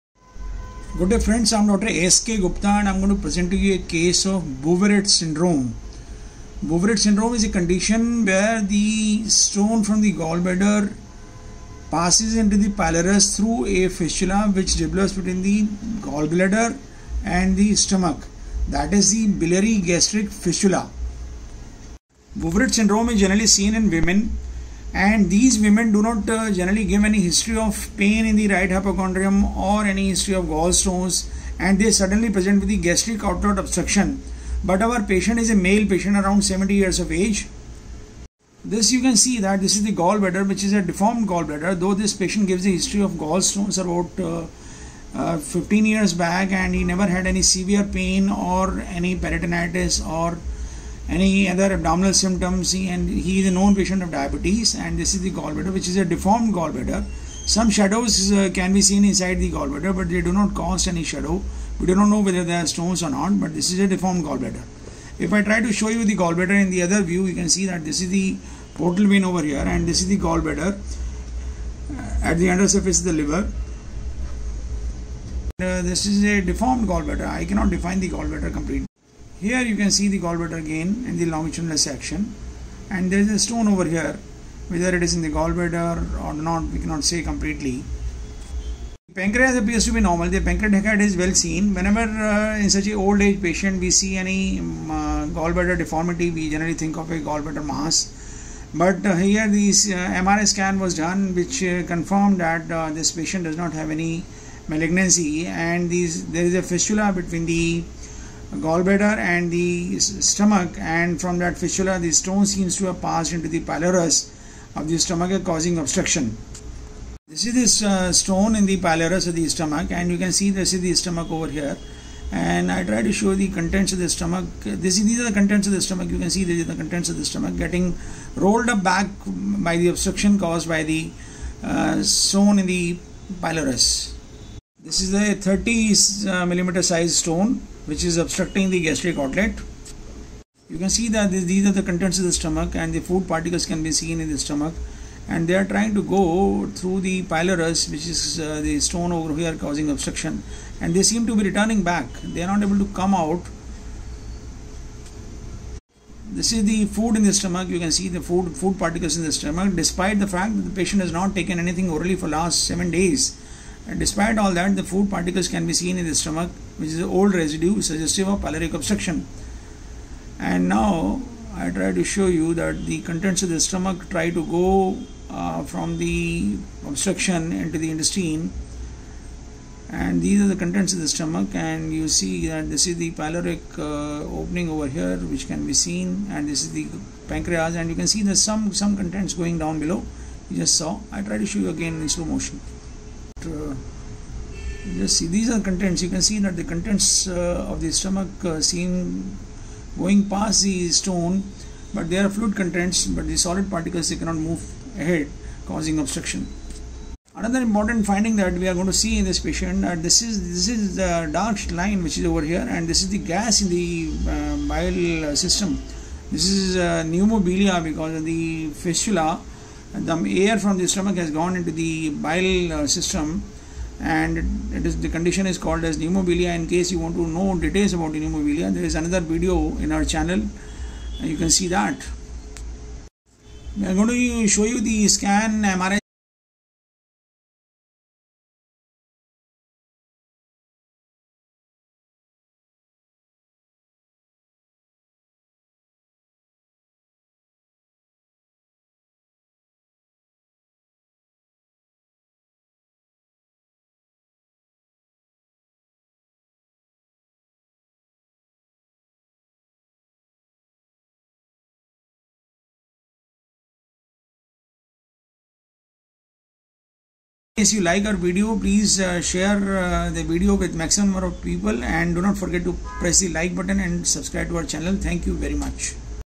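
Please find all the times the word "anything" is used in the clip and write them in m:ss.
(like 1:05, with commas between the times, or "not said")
2:41.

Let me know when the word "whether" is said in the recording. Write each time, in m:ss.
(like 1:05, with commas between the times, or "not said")
1:02, 1:24.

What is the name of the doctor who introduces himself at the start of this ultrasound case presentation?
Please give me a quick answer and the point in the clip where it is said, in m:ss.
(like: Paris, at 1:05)
Dr. S.K. Gupta, at 0:01.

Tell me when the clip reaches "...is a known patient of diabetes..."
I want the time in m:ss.
0:53.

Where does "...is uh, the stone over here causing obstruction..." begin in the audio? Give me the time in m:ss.
2:28.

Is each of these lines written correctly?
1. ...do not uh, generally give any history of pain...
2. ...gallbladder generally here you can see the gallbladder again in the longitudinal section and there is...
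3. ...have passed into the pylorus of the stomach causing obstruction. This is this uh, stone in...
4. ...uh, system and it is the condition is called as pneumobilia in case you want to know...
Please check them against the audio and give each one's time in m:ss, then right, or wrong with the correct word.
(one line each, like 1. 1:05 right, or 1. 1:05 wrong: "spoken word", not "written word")
1. 0:25 right
2. 1:18 wrong: "completely", not "generally"
3. 1:52 right
4. 3:42 right.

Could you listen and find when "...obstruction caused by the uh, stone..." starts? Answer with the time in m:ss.
2:09.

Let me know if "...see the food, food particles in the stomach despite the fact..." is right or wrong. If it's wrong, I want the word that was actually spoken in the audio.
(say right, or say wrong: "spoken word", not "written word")
right.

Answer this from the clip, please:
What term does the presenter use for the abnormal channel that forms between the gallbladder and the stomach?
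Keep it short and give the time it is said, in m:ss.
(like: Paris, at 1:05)
biliary gastric fistula, at 0:19.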